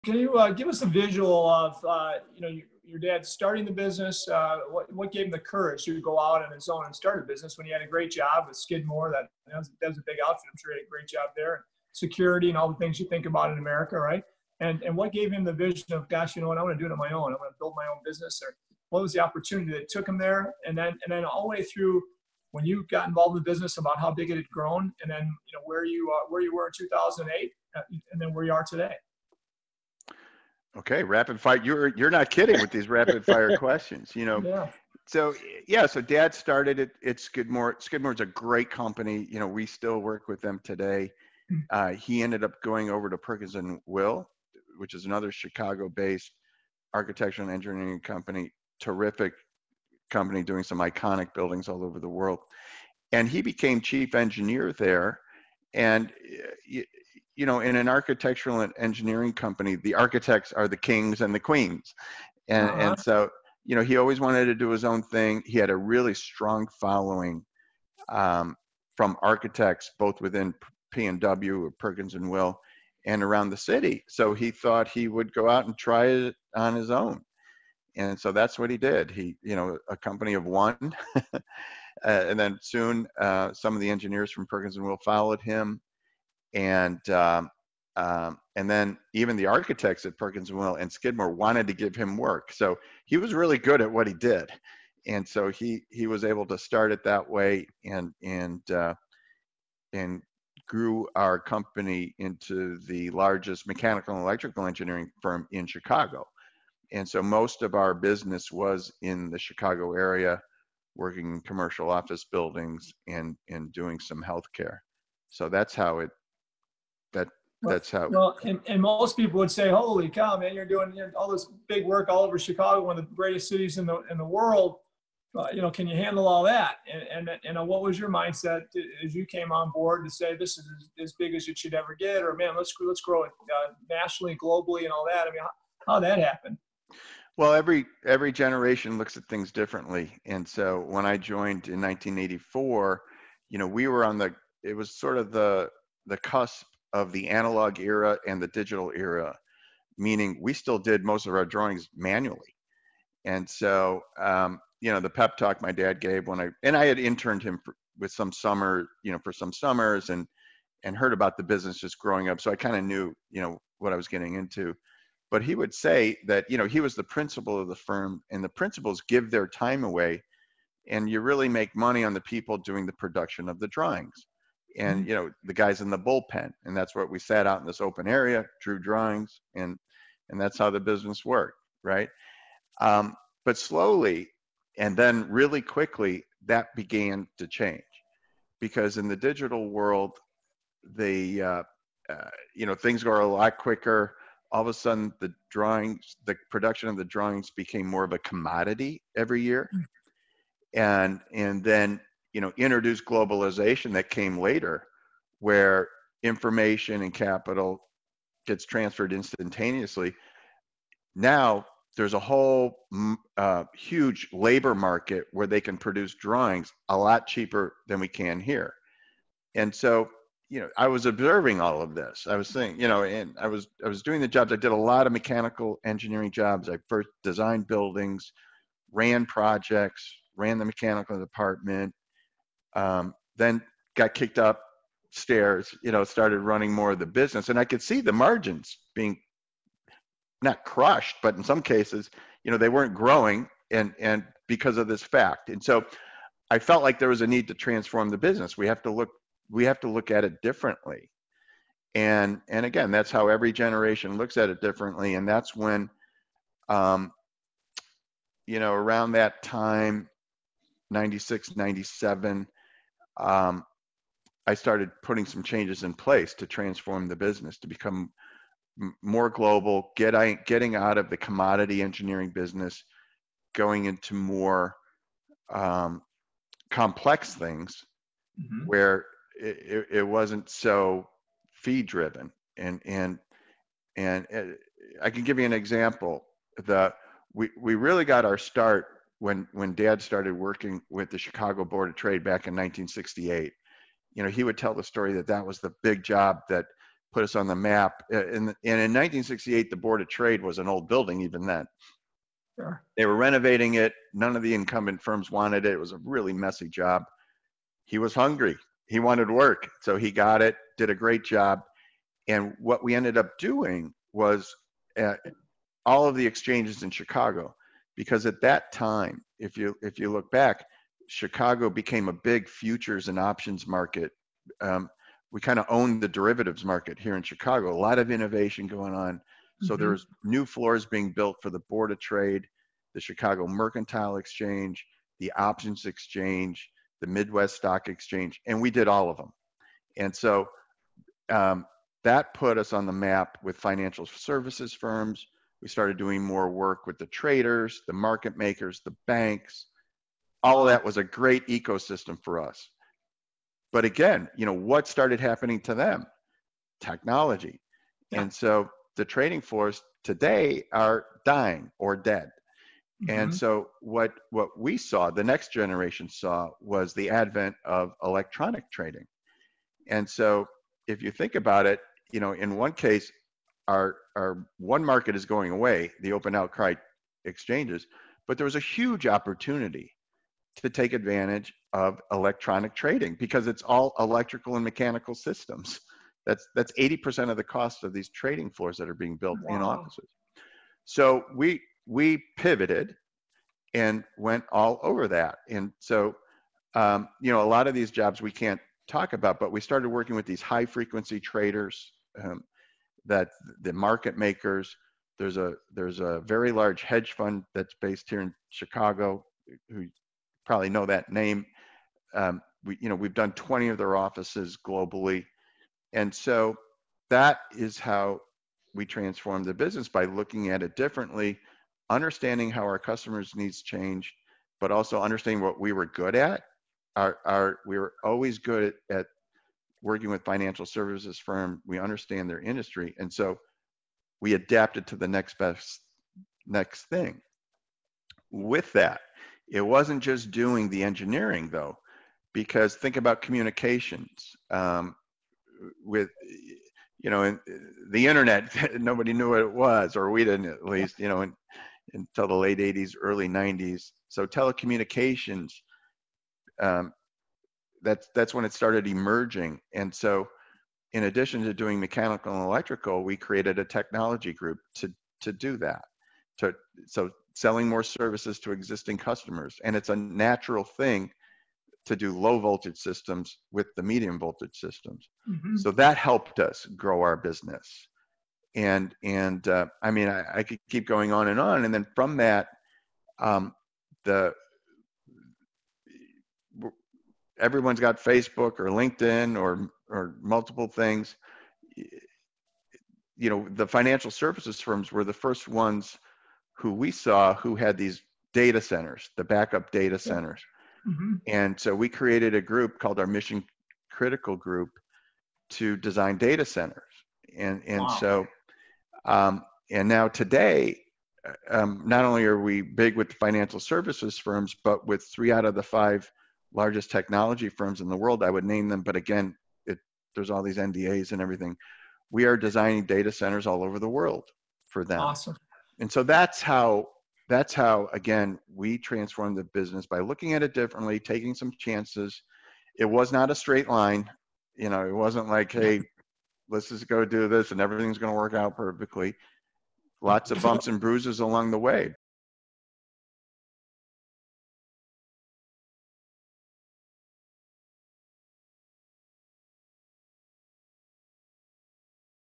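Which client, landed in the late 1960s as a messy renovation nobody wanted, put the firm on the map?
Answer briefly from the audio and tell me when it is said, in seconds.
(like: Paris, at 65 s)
Chicago Board of Trade, at 291 s.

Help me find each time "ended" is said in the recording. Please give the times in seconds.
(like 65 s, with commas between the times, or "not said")
42 s, 312 s.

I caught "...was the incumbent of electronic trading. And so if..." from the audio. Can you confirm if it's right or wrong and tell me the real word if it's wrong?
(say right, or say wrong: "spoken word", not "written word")
wrong: "advent", not "incumbent".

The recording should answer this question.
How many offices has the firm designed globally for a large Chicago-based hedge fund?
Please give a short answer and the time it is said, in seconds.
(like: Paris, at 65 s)
20, at 413 s.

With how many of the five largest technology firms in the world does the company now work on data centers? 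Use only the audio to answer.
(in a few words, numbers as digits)
3.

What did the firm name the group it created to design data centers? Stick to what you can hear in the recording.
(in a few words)
Mission Critical Group.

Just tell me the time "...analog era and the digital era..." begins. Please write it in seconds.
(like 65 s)
147 s.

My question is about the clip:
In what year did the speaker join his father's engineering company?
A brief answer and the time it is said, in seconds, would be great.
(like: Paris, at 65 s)
1984, at 141 s.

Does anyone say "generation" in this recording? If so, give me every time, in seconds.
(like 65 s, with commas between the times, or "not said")
138 s, 253 s, 365 s.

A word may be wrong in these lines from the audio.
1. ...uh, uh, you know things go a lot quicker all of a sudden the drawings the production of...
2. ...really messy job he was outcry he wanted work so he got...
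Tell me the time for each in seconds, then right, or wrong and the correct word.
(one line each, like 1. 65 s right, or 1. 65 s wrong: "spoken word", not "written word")
1. 191 s right
2. 306 s wrong: "hungry", not "outcry".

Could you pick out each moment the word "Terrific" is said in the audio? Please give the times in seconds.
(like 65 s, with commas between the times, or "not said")
48 s.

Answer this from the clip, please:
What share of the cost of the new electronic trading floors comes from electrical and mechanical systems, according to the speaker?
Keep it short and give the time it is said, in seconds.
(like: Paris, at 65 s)
80%, at 386 s.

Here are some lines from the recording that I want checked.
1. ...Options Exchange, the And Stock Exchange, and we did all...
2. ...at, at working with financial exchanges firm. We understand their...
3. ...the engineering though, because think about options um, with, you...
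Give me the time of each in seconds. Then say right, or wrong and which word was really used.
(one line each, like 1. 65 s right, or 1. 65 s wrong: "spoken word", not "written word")
1. 335 s wrong: "Midwest", not "And"
2. 428 s wrong: "services", not "exchanges"
3. 440 s wrong: "communications", not "options".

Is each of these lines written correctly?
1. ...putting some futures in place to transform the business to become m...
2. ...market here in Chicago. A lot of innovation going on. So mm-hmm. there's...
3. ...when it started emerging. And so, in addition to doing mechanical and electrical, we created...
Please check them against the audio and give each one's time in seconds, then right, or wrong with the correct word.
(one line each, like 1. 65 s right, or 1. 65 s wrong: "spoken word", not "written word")
1. 265 s wrong: "changes", not "futures"
2. 326 s right
3. 458 s right.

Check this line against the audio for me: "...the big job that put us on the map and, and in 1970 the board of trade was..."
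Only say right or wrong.
wrong.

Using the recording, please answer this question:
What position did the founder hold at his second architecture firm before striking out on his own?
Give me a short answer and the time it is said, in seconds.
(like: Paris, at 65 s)
chief engineer, at 53 s.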